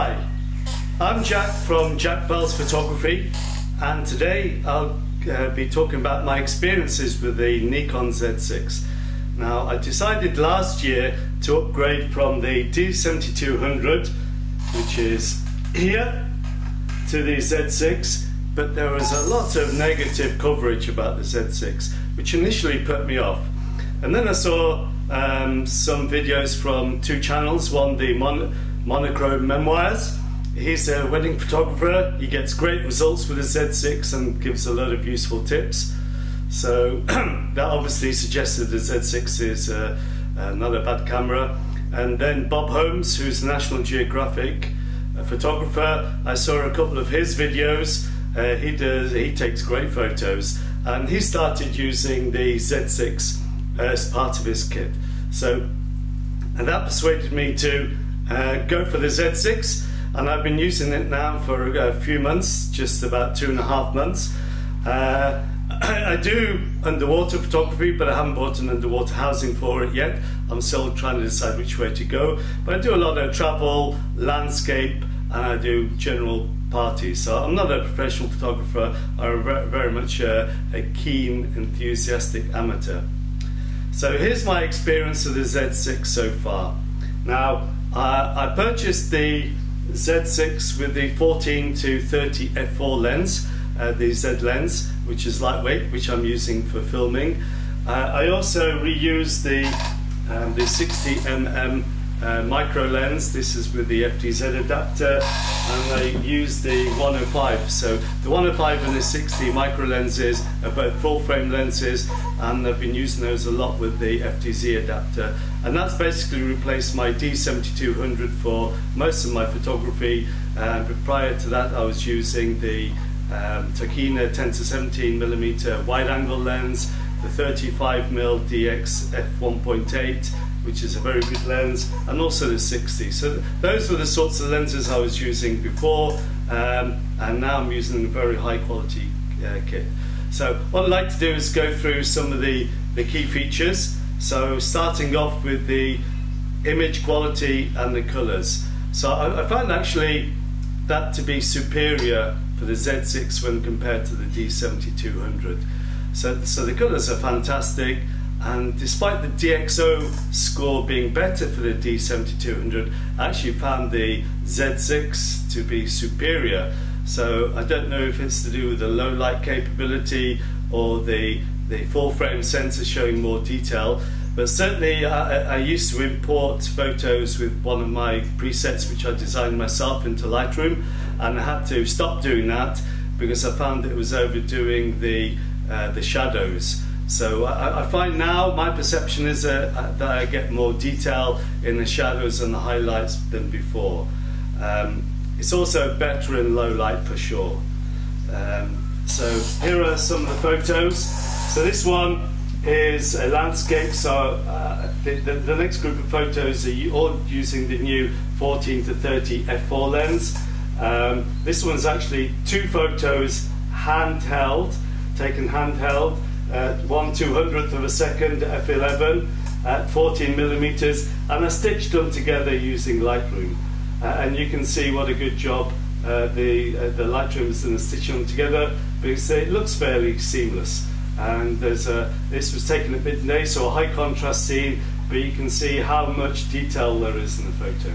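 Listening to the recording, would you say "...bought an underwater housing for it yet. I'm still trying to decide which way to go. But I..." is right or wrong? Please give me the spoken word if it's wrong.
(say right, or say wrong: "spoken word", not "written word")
right.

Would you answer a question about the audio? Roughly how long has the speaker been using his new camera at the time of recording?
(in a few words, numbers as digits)
2 and a half months.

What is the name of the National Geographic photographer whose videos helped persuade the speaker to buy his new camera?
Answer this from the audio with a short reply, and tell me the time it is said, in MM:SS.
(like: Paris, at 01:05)
Bob Holmes, at 00:42.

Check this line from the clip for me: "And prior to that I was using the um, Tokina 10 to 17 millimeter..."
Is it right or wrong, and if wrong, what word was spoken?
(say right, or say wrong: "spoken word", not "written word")
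right.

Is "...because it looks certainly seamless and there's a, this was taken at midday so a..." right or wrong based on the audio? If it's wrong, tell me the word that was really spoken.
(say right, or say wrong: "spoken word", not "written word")
wrong: "fairly", not "certainly".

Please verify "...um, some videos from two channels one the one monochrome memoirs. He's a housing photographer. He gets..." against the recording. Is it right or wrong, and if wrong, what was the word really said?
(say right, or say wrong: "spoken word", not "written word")
wrong: "wedding", not "housing".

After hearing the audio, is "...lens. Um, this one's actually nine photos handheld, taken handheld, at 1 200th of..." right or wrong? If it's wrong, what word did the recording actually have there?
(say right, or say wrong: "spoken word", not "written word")
wrong: "two", not "nine".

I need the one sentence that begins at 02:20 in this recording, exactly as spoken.
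So what I'd like to do is go through some of the, the key features.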